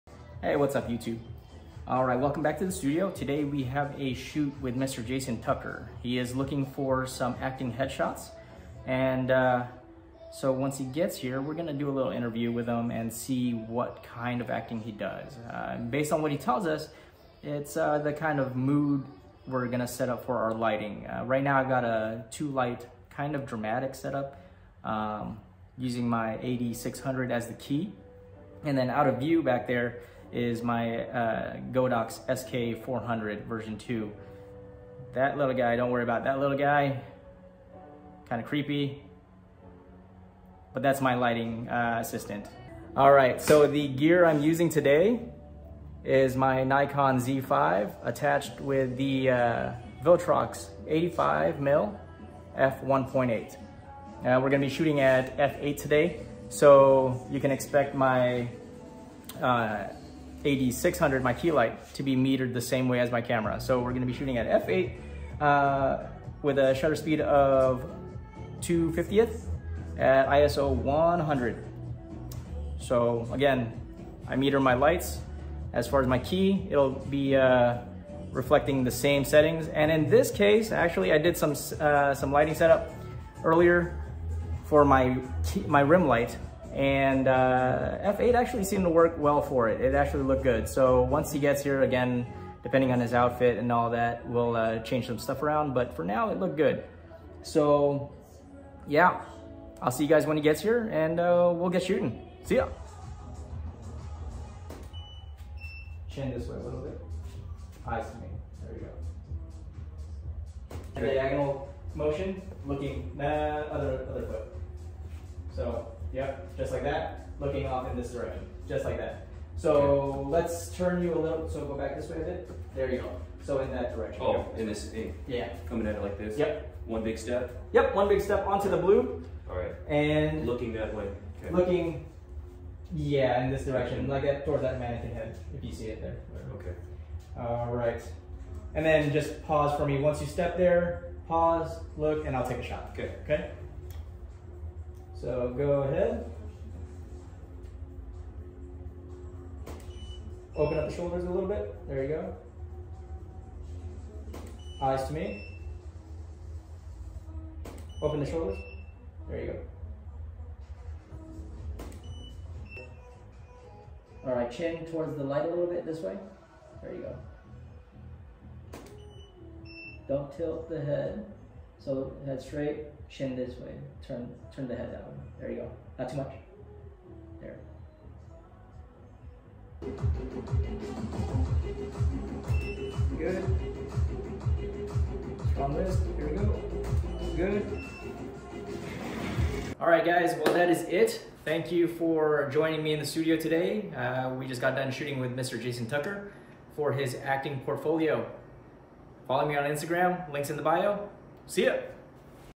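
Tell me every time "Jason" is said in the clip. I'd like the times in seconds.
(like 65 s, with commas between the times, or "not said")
5 s, 195 s.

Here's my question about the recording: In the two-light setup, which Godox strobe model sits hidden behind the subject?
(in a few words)
SK400 version 2.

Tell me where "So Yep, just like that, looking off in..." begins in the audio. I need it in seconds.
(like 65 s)
115 s.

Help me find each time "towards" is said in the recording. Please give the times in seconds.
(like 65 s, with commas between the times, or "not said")
134 s, 164 s.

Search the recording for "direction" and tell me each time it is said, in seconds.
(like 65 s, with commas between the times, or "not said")
118 s, 123 s, 133 s.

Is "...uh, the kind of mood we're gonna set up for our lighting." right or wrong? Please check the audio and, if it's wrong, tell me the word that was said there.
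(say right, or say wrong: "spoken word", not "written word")
right.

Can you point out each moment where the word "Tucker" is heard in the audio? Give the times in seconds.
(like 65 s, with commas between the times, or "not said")
5 s, 195 s.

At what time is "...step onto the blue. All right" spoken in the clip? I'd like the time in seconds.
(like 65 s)
128 s.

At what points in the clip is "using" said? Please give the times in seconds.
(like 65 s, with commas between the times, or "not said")
25 s, 44 s.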